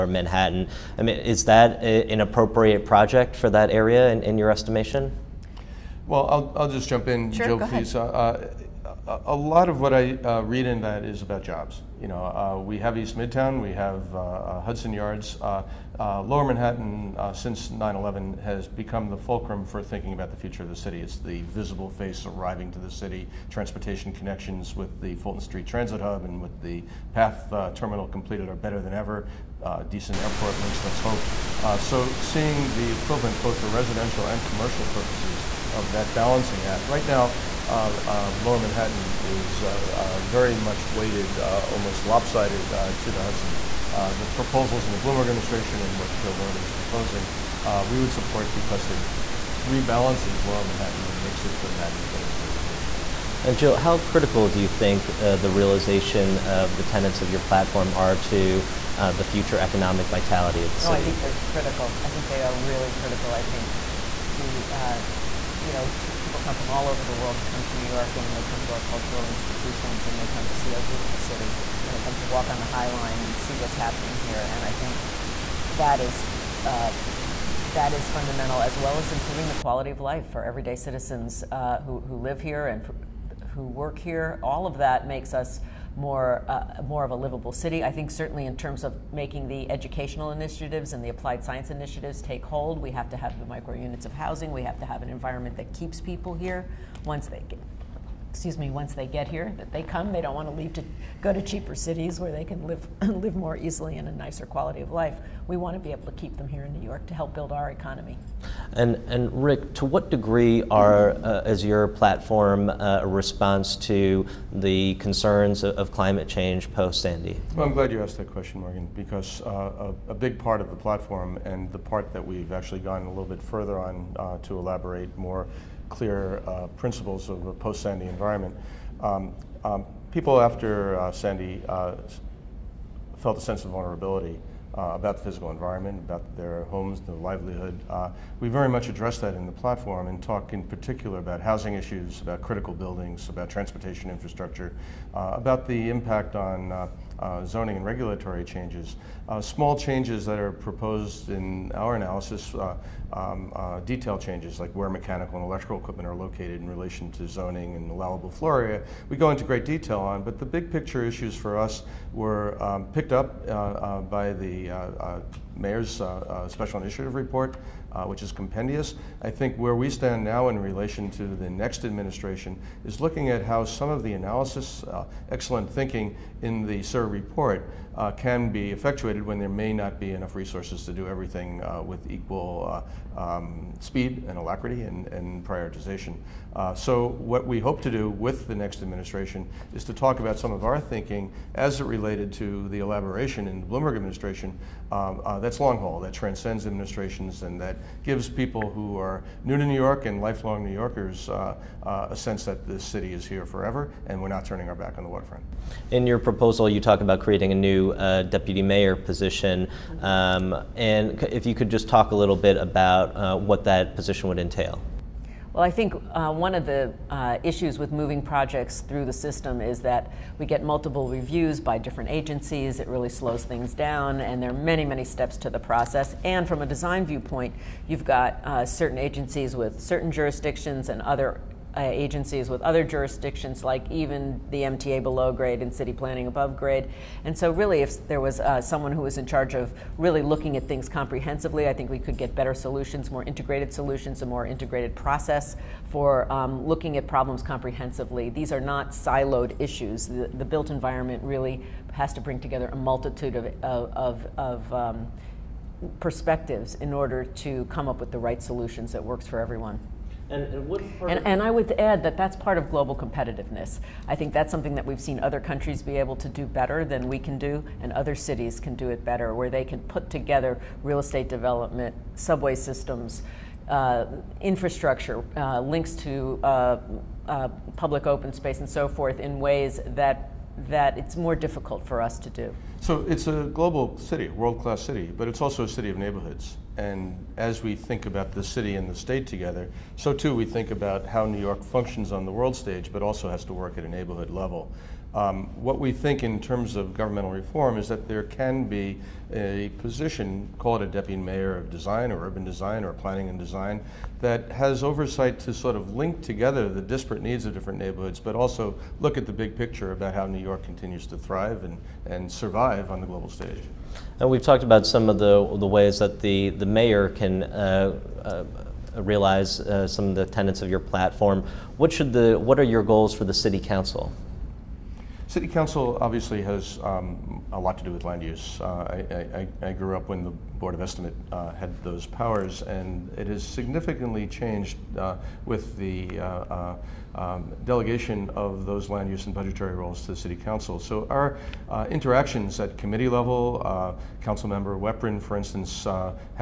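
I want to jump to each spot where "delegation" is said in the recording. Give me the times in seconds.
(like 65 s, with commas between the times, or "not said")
337 s.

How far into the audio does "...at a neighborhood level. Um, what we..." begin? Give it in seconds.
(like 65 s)
293 s.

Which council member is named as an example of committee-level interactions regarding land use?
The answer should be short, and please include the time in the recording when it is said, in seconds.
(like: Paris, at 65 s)
Weprin, at 344 s.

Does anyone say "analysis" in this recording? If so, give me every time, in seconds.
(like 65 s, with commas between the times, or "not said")
151 s, 174 s.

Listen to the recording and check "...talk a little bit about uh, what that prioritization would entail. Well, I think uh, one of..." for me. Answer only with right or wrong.
wrong.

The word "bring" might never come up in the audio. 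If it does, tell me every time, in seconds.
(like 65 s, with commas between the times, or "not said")
252 s.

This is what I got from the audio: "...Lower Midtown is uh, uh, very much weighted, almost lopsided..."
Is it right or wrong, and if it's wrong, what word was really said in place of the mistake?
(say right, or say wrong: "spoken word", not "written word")
wrong: "Manhattan", not "Midtown".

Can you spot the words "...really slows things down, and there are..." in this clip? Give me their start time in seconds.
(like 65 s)
222 s.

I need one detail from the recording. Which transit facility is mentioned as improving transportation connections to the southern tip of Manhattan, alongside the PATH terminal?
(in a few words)
Fulton Street Transit Hub.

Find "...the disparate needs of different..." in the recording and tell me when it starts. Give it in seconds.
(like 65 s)
306 s.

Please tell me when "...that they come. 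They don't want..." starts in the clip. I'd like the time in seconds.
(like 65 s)
99 s.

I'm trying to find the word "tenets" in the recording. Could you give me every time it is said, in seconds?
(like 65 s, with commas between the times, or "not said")
56 s, 320 s.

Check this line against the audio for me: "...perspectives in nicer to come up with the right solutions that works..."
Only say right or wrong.
wrong.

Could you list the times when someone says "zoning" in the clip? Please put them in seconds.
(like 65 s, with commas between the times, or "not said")
147 s, 157 s.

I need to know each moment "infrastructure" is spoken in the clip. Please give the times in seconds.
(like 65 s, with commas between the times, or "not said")
144 s, 274 s.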